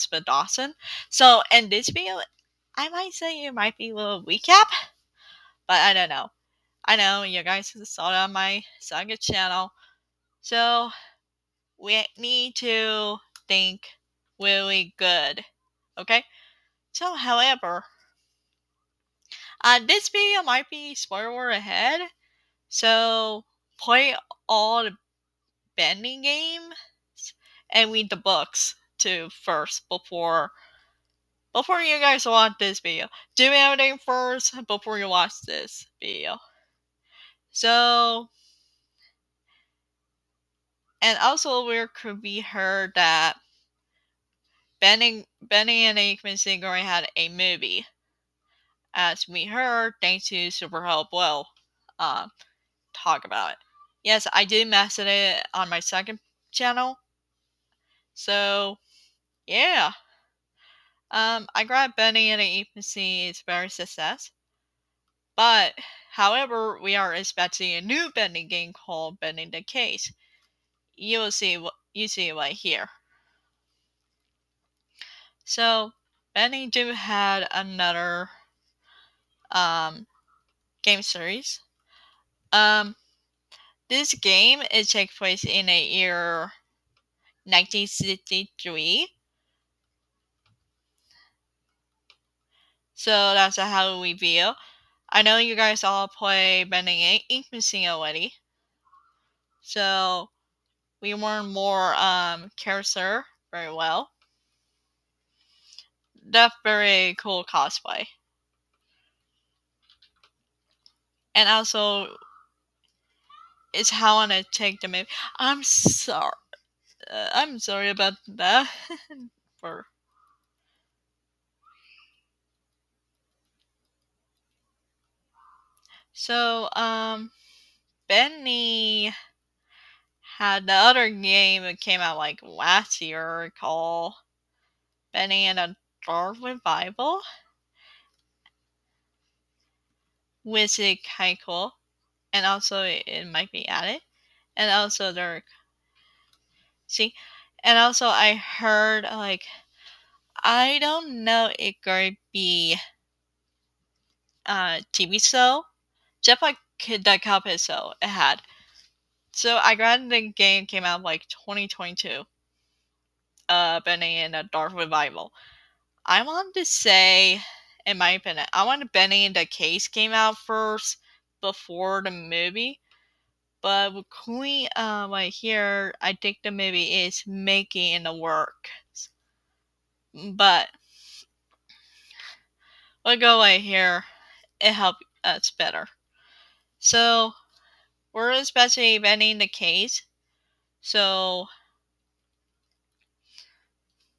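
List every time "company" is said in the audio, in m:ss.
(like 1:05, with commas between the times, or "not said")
not said.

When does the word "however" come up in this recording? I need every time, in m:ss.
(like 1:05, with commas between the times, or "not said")
0:17, 1:06.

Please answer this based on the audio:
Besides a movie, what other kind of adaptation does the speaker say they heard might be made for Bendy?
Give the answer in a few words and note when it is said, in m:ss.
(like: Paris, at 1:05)
TV show, at 2:34.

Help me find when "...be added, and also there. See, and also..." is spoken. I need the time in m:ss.
2:23.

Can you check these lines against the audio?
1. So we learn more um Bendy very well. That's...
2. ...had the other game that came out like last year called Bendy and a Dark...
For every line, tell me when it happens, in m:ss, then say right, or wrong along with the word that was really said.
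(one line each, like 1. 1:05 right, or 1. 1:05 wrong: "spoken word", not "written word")
1. 1:39 wrong: "Carousel", not "Bendy"
2. 2:10 right.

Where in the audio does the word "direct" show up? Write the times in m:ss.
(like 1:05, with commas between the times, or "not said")
not said.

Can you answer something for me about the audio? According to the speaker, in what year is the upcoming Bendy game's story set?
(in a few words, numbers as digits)
1963.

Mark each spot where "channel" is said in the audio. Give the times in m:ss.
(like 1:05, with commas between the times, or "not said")
0:09, 0:56.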